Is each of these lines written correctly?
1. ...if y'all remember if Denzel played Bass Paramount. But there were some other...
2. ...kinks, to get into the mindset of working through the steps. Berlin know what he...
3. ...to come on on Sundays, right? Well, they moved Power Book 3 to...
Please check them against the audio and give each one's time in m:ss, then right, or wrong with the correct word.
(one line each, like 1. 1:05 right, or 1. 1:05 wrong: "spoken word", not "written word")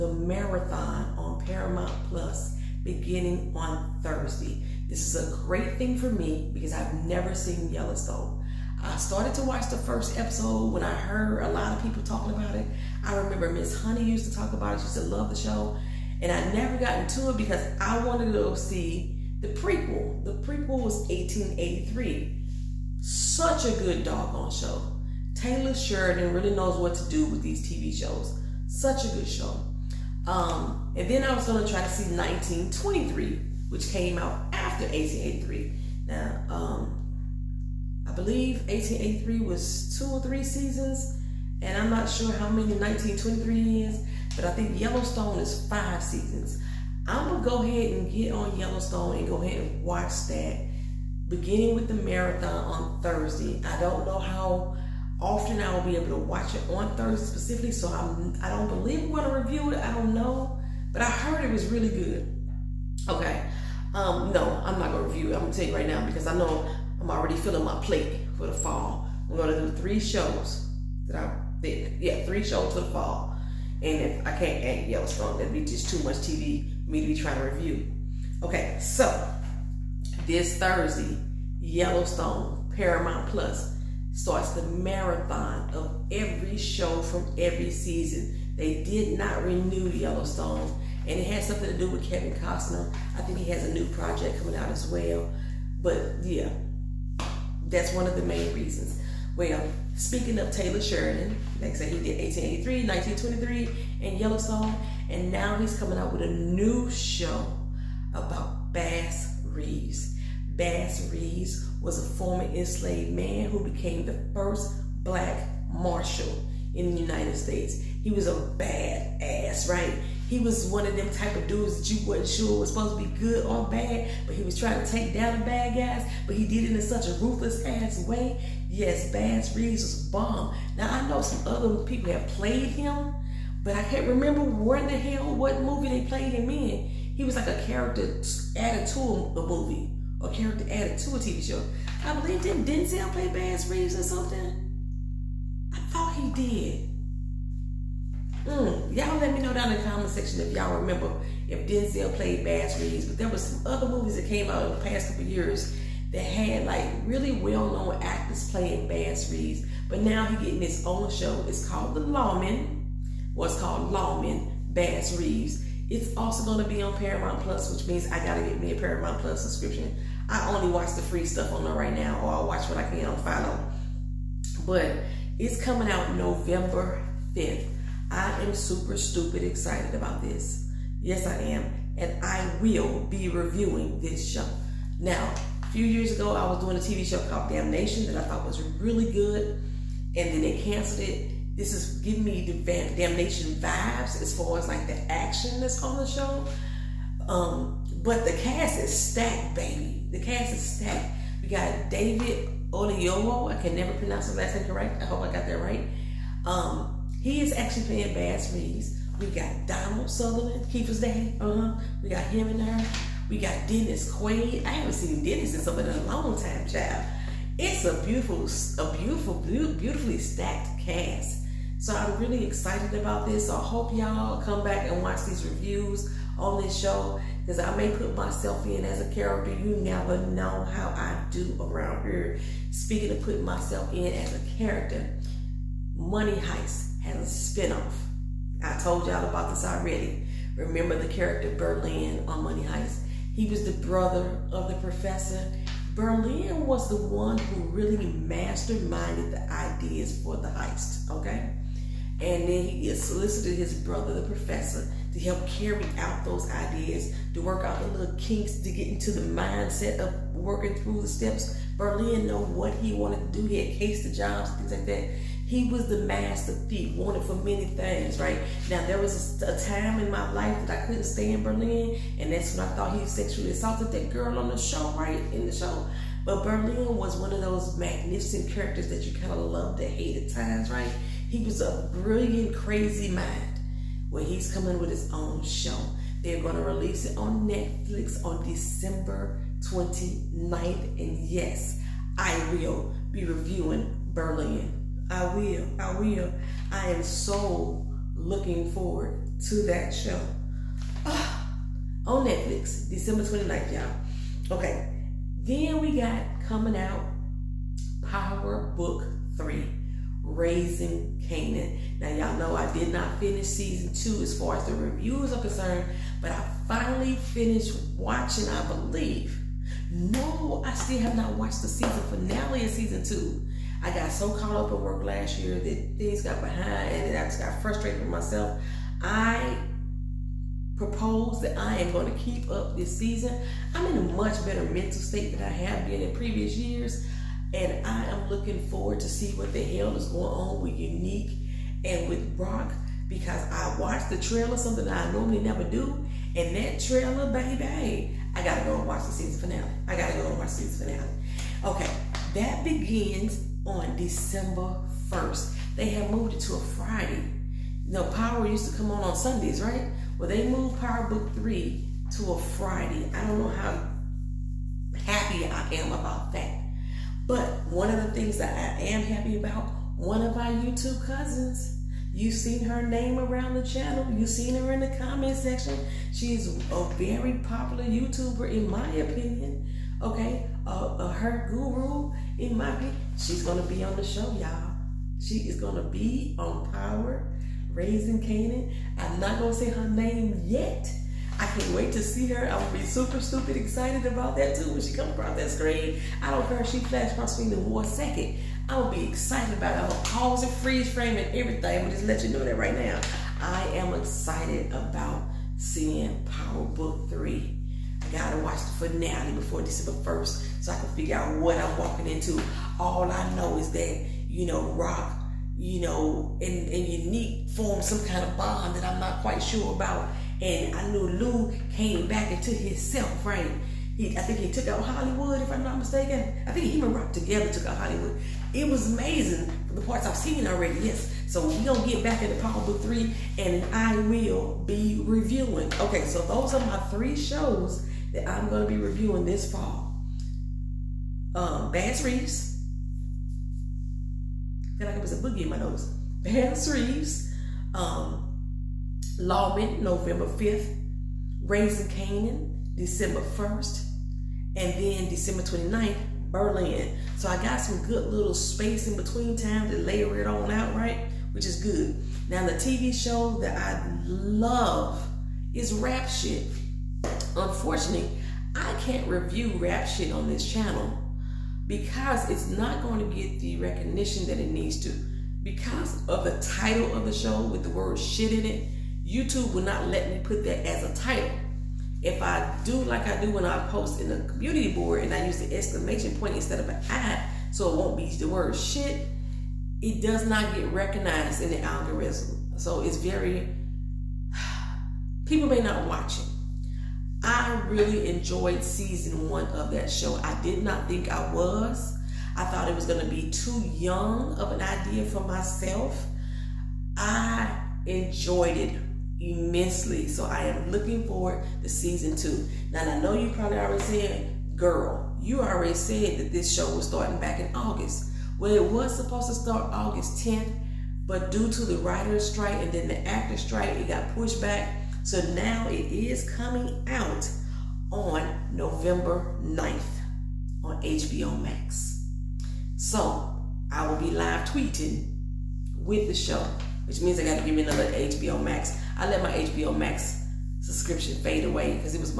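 1. 2:30 wrong: "Reeves", not "Paramount"
2. 4:18 right
3. 5:58 right.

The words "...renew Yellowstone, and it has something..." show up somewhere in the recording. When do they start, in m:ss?
1:29.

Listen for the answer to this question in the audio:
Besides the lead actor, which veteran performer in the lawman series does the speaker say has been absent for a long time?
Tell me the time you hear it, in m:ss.
3:33.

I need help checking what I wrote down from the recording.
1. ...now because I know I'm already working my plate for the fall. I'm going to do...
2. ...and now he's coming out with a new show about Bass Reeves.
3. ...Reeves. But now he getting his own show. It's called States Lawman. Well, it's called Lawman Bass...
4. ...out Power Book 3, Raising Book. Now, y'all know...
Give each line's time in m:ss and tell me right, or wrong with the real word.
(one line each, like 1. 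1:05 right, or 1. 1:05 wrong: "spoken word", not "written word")
1. 1:05 wrong: "filling", not "working"
2. 1:45 right
3. 2:39 wrong: "The", not "States"
4. 5:06 wrong: "Kanan", not "Book".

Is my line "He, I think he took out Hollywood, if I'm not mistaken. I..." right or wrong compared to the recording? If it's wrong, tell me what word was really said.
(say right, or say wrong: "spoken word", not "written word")
right.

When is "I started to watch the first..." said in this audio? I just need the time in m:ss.
0:08.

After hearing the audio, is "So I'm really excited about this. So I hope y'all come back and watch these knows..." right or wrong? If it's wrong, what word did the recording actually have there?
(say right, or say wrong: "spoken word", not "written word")
wrong: "reviews", not "knows".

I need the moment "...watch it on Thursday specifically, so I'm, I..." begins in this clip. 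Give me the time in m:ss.
0:56.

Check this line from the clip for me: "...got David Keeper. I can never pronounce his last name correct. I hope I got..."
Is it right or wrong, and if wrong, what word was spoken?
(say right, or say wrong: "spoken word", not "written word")
wrong: "Oyelowo", not "Keeper".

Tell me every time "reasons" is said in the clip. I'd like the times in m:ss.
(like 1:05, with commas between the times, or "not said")
1:38.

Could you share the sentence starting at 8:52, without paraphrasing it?
So I will be live tweeting with the show, which means I got to give me another HBO Max.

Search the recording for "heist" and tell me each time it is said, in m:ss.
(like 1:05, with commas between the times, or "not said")
3:56, 4:02, 4:10.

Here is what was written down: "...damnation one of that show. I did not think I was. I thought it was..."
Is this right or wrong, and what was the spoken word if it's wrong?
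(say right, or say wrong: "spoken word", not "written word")
wrong: "season", not "damnation".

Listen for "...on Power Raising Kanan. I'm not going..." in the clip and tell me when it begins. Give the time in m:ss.
6:26.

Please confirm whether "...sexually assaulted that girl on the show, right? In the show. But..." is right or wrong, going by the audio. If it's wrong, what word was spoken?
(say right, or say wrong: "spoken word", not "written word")
right.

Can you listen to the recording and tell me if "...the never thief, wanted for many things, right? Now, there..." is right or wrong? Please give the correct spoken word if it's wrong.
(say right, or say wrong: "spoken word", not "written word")
wrong: "master", not "never".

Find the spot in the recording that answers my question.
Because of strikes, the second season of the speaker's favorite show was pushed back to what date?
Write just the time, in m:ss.
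8:48.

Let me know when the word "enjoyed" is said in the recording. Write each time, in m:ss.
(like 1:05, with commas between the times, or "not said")
8:18, 8:27.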